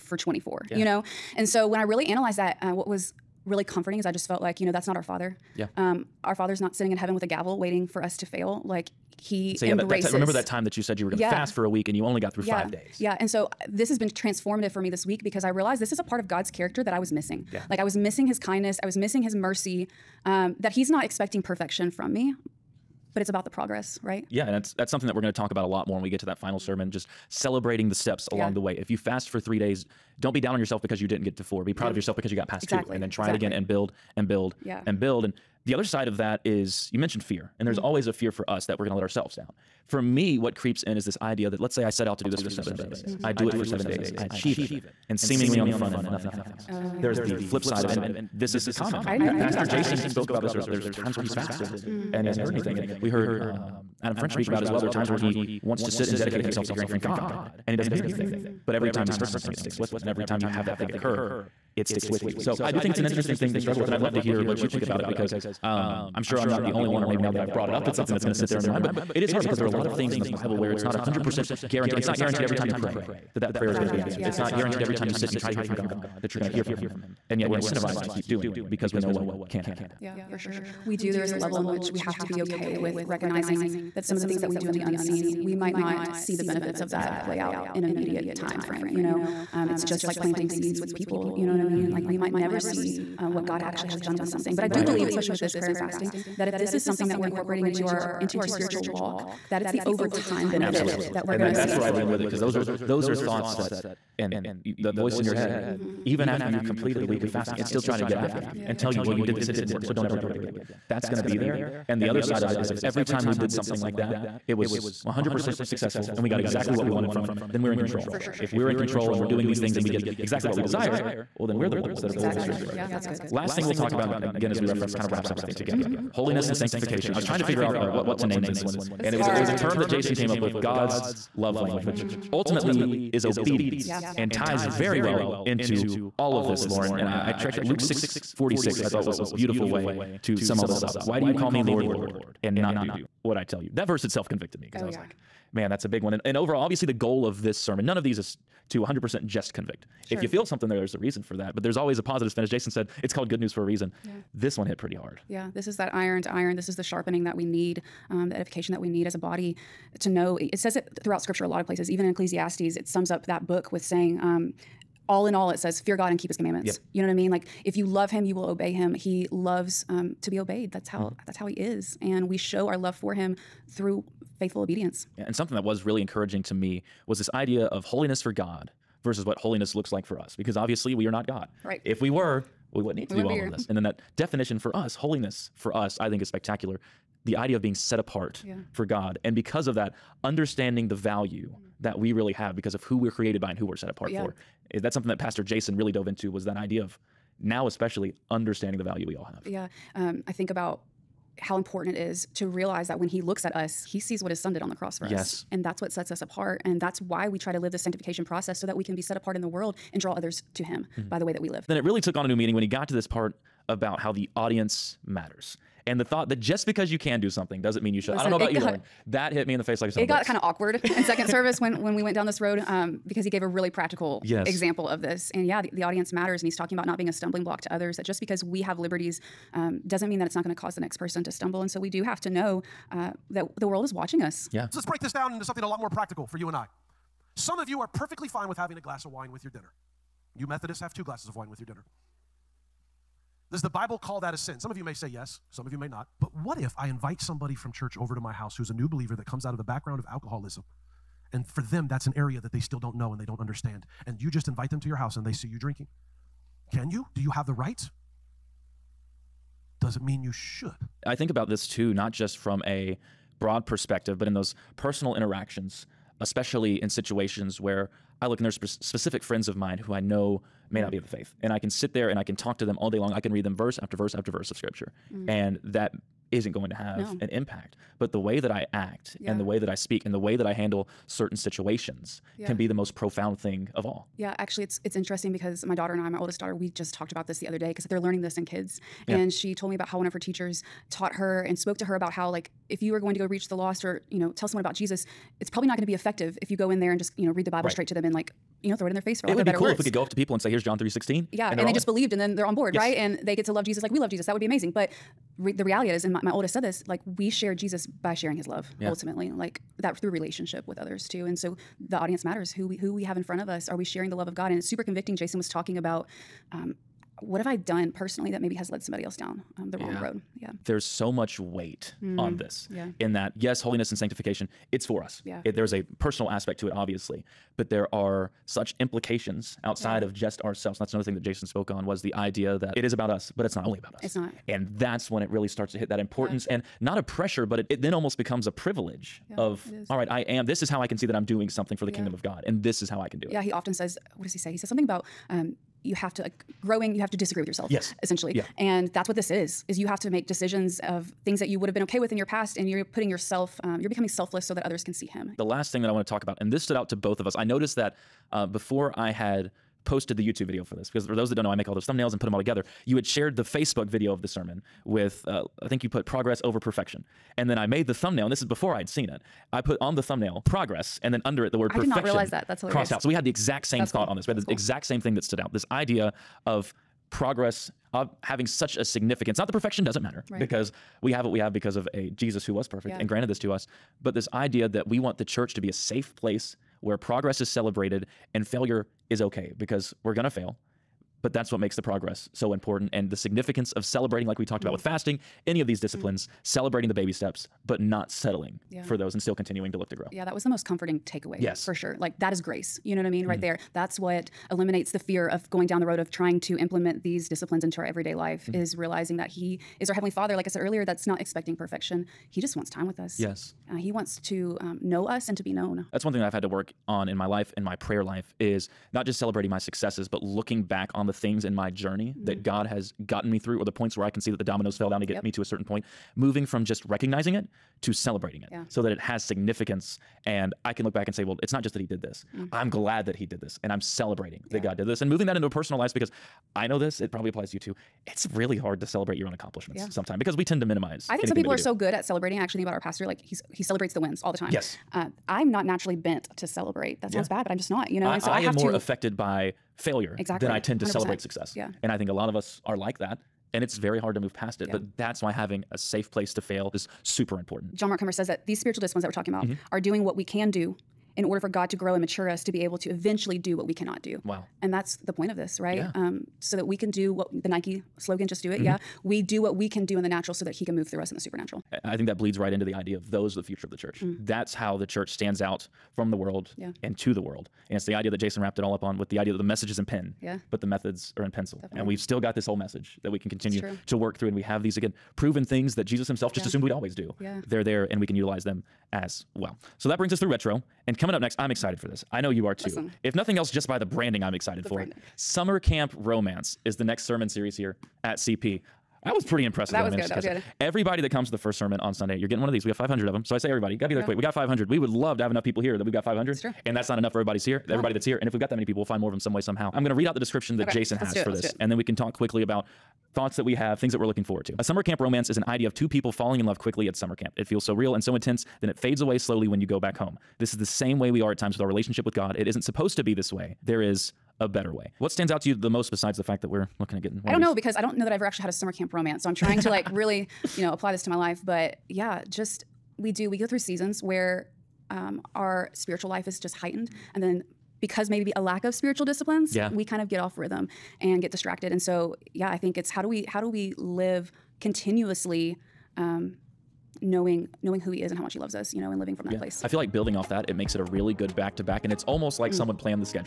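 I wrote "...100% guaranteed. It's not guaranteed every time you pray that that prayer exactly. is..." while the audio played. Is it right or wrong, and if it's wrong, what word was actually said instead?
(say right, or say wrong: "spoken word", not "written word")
right.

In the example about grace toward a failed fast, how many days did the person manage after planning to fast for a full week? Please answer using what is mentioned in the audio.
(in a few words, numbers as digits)
5.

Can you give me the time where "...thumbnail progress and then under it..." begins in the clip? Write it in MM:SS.
06:10.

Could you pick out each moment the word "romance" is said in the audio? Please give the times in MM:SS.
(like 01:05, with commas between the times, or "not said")
08:15, 08:35, 08:48.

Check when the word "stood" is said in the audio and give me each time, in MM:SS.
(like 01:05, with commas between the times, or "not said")
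05:56, 06:15.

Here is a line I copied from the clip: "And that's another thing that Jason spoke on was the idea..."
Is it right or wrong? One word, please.
right.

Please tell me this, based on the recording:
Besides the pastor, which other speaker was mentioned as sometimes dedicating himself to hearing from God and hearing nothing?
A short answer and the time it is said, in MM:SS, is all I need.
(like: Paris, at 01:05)
Adam French, at 00:54.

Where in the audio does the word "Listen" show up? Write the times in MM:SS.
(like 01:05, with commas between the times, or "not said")
03:38, 08:12.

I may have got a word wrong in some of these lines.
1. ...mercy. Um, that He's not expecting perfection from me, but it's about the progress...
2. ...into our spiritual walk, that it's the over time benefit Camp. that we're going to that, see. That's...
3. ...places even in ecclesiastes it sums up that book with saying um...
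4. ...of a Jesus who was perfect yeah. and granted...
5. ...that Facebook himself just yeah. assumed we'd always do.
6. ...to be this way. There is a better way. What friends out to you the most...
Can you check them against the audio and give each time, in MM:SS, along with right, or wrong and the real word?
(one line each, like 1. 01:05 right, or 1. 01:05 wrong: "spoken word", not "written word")
1. 00:19 right
2. 01:38 wrong: "Absolutely", not "Camp"
3. 02:41 right
4. 06:21 right
5. 08:05 wrong: "Jesus", not "Facebook"
6. 08:42 wrong: "stands", not "friends".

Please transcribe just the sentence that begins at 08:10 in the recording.
And coming up next, I'm excited for this.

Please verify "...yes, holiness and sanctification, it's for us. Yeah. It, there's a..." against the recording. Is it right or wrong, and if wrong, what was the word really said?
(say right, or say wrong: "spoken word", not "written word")
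right.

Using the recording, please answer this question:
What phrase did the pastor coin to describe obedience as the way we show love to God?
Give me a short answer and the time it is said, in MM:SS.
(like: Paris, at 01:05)
God's love language, at 02:10.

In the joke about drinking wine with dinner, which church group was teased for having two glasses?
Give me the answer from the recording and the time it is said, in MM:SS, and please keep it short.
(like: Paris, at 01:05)
Methodists, at 04:00.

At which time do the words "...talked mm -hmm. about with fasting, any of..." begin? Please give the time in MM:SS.
06:34.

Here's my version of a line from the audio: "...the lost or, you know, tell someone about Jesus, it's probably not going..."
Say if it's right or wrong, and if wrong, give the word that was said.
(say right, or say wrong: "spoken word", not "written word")
right.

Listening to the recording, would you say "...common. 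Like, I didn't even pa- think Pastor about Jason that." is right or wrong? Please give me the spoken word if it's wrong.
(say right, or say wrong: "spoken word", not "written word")
right.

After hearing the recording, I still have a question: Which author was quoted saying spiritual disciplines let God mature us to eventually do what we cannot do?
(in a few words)
John Mark Comer.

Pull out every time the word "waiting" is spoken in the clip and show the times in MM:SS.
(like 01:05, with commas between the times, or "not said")
00:07.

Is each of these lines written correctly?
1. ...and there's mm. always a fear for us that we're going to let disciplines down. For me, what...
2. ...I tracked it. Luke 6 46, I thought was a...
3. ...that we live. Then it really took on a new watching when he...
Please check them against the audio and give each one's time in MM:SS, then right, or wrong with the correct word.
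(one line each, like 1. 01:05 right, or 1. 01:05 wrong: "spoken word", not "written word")
1. 00:37 wrong: "ourselves", not "disciplines"
2. 02:17 right
3. 03:31 wrong: "meaning", not "watching".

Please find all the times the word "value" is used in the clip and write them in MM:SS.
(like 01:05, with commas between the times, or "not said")
03:10, 03:18.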